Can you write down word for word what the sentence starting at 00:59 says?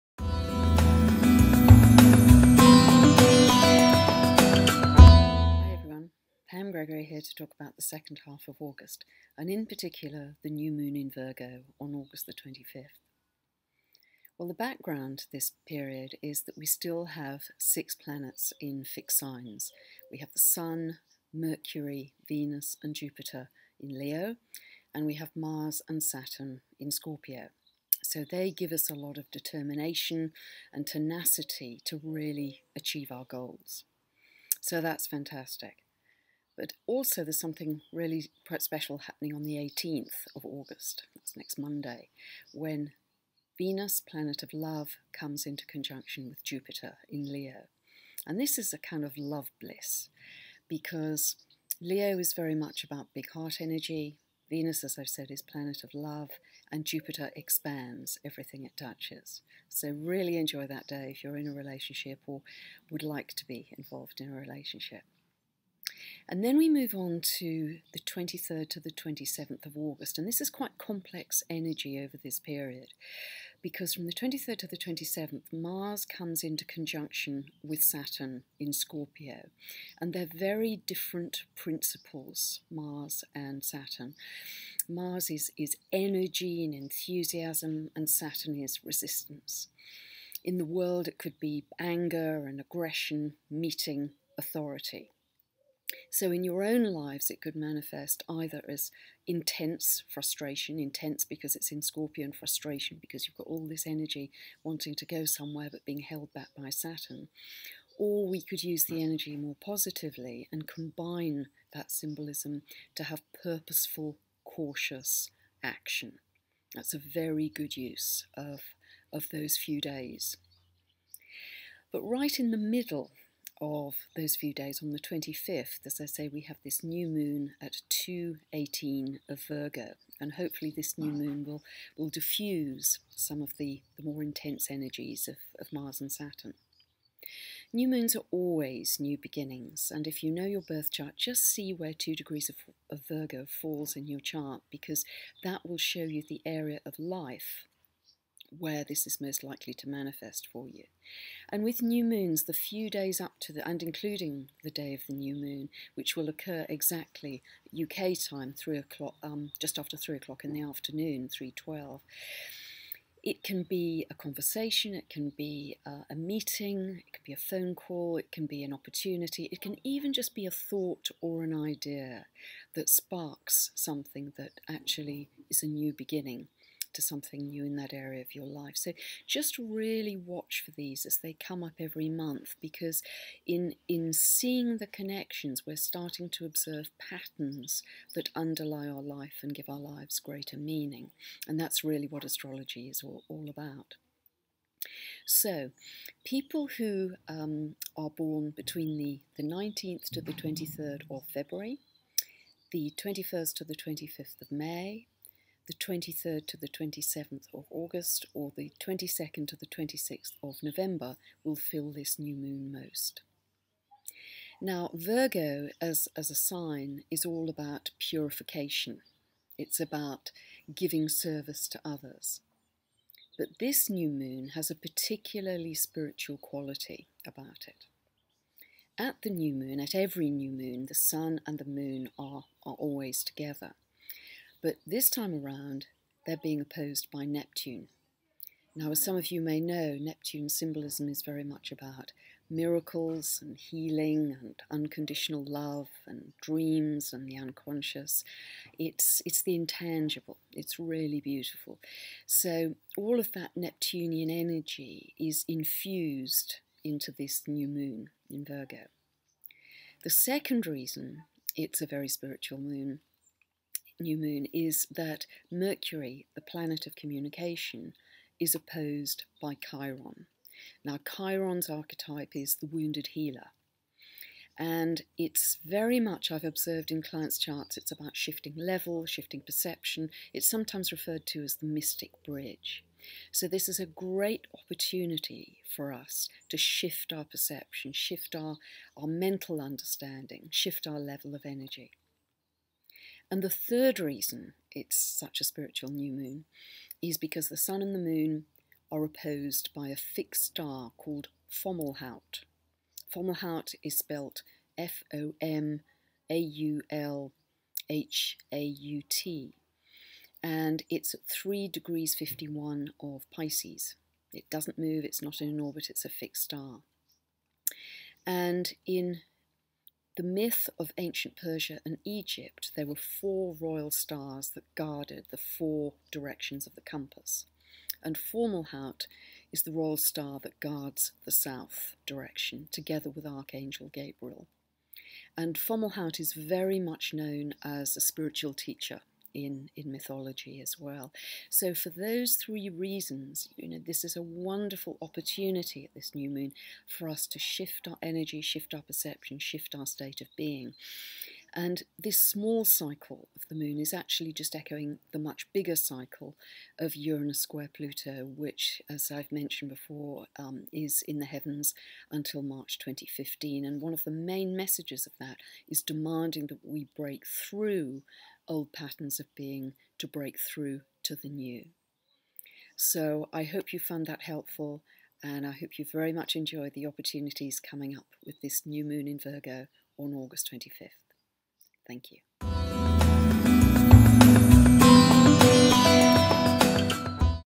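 So, really enjoy that day if you're in a relationship or would like to be involved in a relationship.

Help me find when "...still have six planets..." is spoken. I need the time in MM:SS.
00:16.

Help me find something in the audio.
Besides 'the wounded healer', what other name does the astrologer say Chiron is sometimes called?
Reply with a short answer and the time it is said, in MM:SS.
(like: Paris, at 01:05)
the mystic bridge, at 04:41.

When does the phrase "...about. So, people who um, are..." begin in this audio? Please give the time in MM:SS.
03:13.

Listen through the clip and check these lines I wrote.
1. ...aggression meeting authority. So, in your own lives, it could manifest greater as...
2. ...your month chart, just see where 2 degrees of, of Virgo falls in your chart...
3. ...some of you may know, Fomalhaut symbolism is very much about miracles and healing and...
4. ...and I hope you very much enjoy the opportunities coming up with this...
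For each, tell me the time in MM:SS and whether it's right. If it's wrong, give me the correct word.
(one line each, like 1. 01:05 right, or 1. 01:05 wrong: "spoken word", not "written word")
1. 01:32 wrong: "either", not "greater"
2. 02:20 wrong: "birth", not "month"
3. 03:59 wrong: "Neptune", not "Fomalhaut"
4. 06:15 right.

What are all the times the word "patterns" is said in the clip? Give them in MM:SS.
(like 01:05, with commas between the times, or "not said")
03:06, 06:08.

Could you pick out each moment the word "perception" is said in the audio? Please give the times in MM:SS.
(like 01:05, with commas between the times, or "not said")
04:39, 04:47, 05:48.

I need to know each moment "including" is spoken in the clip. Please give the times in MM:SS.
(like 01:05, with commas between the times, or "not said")
02:33.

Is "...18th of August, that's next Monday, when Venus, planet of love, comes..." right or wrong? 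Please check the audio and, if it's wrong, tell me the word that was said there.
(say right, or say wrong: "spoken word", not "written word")
right.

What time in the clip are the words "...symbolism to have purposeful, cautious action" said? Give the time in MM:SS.
01:51.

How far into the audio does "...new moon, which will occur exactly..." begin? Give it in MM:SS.
02:35.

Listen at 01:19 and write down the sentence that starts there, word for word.
And they're very different principles, Mars and Saturn.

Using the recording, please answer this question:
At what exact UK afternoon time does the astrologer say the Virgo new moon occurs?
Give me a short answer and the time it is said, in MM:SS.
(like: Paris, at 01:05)
3:12, at 02:41.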